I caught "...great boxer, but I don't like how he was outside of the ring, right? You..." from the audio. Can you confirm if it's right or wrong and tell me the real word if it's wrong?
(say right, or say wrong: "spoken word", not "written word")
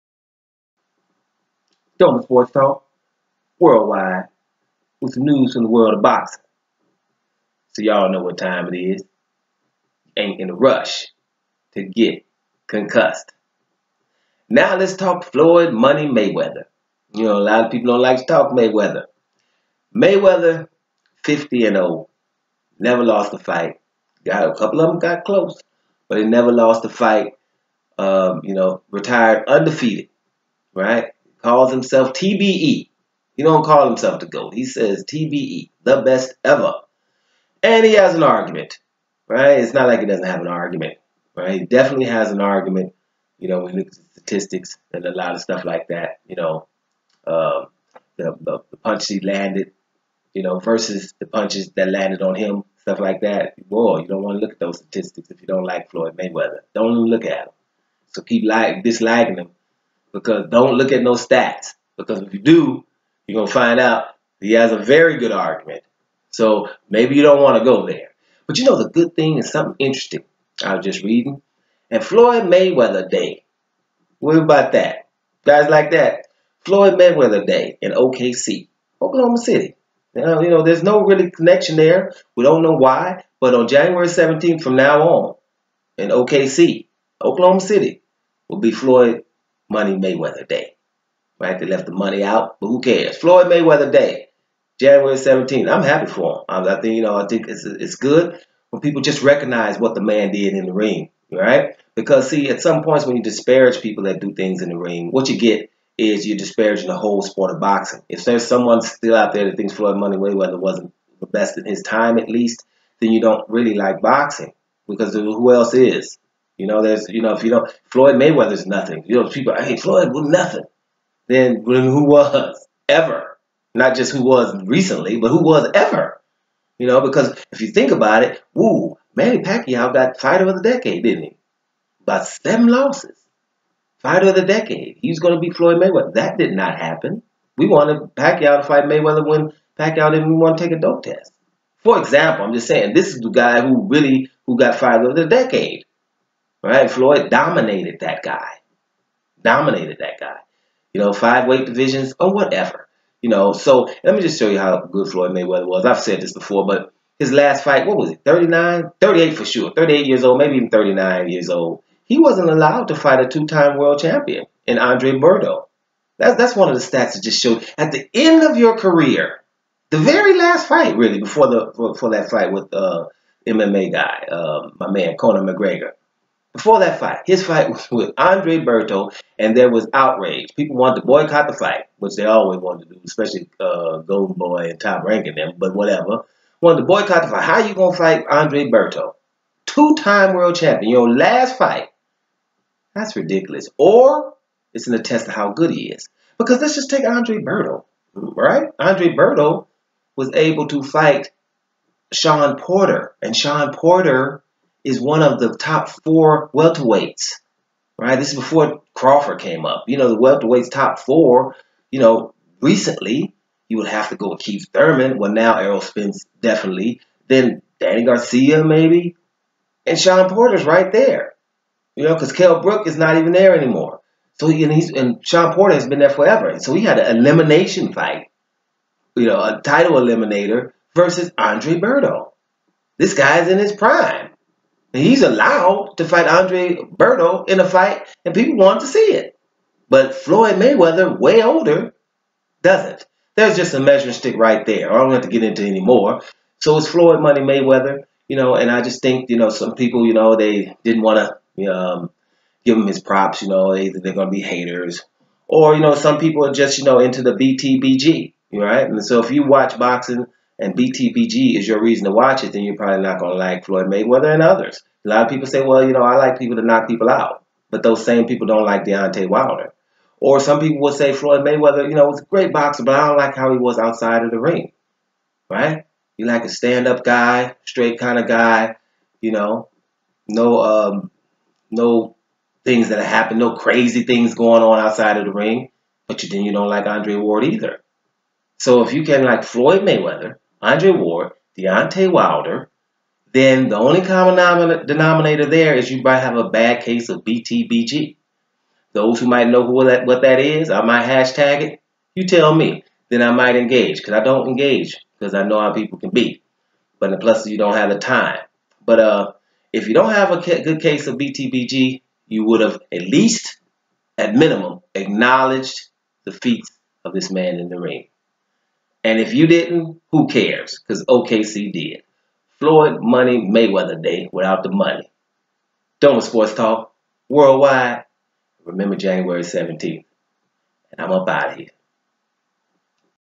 right.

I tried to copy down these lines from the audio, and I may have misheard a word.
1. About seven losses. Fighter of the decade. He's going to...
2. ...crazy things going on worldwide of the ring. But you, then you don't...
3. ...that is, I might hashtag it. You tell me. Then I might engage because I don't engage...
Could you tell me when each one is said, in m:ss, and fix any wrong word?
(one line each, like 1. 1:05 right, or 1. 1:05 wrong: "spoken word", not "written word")
1. 2:12 right
2. 4:43 wrong: "outside", not "worldwide"
3. 5:00 right.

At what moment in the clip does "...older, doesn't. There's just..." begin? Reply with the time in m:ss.
4:01.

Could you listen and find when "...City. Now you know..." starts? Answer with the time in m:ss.
1:19.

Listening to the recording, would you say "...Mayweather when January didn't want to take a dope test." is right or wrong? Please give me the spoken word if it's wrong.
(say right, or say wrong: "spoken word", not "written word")
wrong: "Pacquiao", not "January".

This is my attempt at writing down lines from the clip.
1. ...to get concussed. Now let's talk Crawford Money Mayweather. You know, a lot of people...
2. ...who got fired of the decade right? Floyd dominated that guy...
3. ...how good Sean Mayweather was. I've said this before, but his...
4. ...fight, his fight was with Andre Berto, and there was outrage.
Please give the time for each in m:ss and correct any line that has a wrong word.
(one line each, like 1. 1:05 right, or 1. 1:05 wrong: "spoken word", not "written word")
1. 0:11 wrong: "Floyd", not "Crawford"
2. 2:24 right
3. 2:34 wrong: "Floyd", not "Sean"
4. 2:56 right.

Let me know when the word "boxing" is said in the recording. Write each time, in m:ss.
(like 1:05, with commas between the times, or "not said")
0:06, 1:47, 1:53, 4:19.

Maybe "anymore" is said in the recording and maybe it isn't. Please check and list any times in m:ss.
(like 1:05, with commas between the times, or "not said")
3:43.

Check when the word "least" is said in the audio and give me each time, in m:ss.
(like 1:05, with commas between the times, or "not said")
1:52, 5:13.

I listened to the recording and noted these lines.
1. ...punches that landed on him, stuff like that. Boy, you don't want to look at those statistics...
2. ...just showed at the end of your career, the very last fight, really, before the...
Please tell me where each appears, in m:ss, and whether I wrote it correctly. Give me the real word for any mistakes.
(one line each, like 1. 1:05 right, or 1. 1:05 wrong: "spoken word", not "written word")
1. 0:51 right
2. 2:47 right.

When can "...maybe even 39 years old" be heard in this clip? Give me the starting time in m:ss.
2:40.